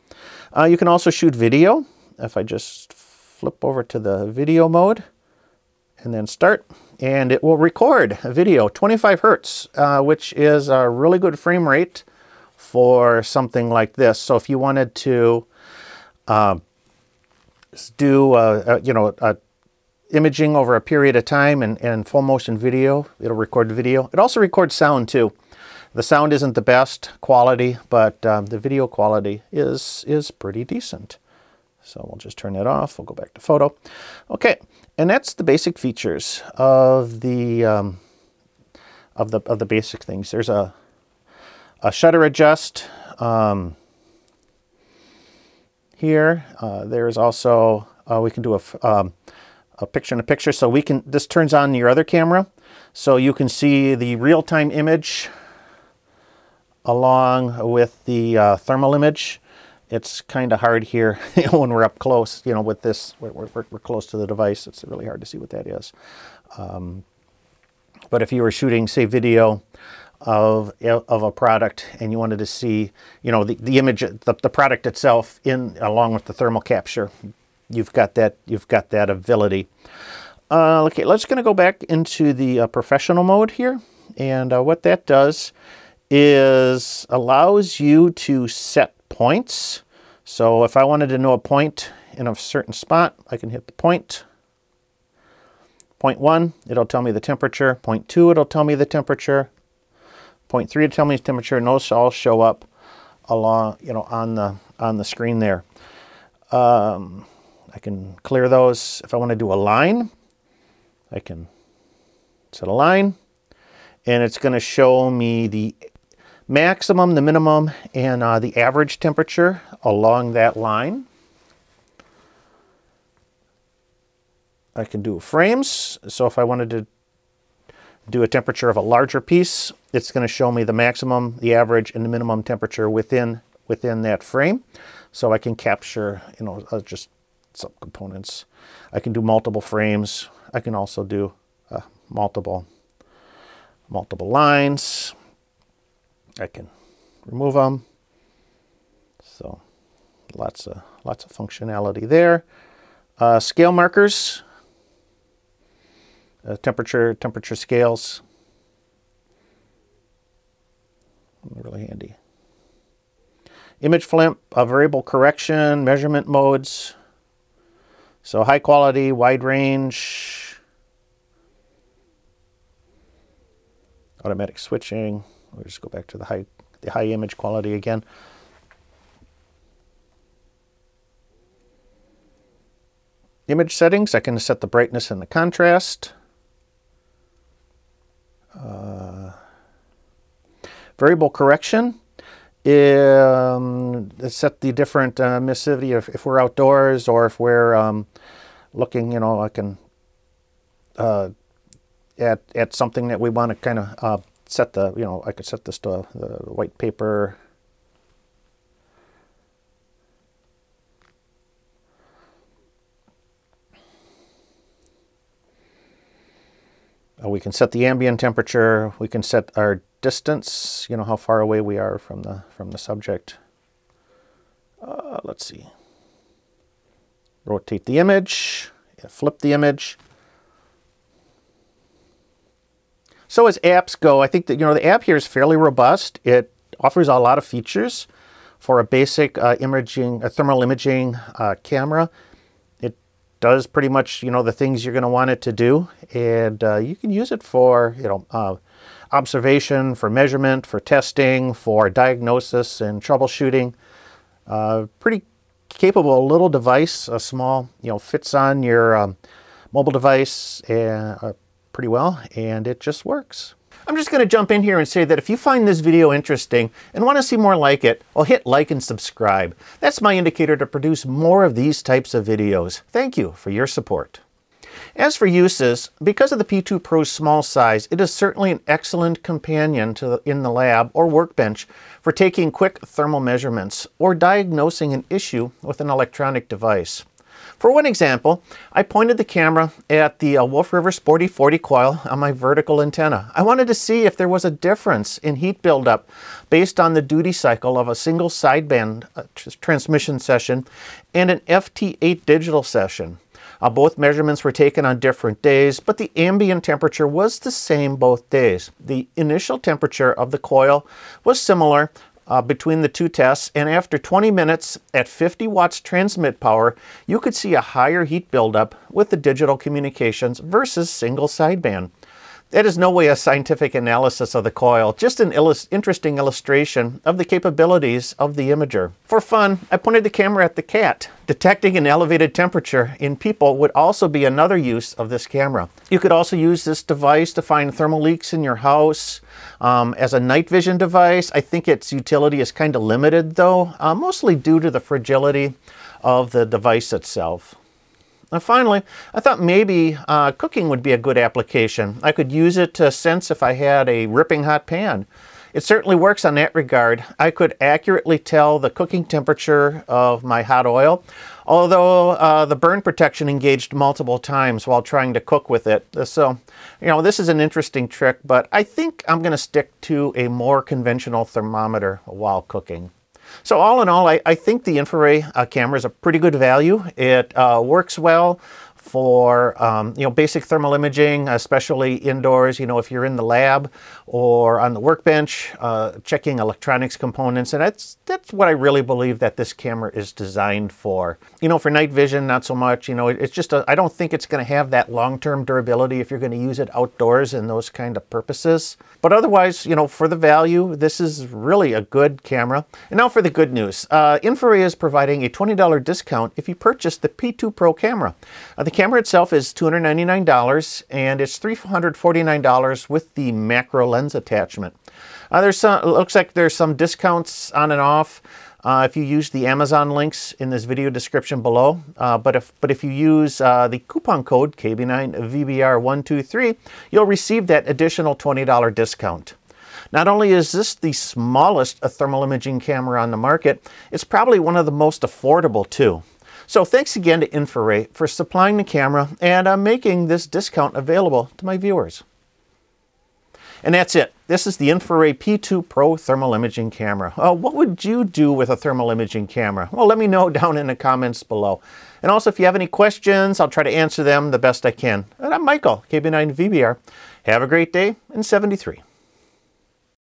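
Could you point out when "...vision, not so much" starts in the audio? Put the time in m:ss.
6:31.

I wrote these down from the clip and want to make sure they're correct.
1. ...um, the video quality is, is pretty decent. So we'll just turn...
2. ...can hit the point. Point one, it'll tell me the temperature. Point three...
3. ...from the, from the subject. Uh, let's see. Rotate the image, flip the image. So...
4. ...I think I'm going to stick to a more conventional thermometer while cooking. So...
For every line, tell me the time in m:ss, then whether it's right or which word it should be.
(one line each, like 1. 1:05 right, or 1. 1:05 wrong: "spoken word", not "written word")
1. 0:28 right
2. 1:33 wrong: "two", not "three"
3. 3:41 right
4. 6:08 right.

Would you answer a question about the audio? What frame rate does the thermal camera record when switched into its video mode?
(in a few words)
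25 hertz.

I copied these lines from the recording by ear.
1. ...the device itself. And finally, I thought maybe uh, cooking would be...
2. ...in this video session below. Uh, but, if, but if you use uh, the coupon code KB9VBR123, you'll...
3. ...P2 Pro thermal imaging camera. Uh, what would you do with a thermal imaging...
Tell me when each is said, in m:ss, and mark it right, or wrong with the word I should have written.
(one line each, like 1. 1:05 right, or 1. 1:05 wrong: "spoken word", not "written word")
1. 5:46 right
2. 7:00 wrong: "description", not "session"
3. 7:25 right.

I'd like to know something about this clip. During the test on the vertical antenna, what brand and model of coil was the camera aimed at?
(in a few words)
Wolf River Sporty 40.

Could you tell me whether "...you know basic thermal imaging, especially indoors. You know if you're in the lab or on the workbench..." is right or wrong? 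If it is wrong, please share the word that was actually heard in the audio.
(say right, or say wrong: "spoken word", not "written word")
right.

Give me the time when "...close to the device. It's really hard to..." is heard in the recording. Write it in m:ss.
1:03.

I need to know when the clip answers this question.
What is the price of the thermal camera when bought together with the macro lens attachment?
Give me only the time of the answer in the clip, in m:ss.
6:51.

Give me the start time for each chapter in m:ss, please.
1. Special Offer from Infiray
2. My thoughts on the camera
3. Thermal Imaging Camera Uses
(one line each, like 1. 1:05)
1. 6:42
2. 6:14
3. 4:23.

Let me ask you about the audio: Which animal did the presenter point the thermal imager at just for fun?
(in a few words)
the cat.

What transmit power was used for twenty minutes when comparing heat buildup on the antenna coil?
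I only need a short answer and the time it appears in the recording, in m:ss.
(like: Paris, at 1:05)
50 watts, at 5:15.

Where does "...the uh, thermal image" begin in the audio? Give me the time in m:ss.
0:58.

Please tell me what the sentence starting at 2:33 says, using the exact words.
Uh, scale markers, uh, temperature, temperature scales.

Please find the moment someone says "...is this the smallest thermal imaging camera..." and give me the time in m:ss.
7:10.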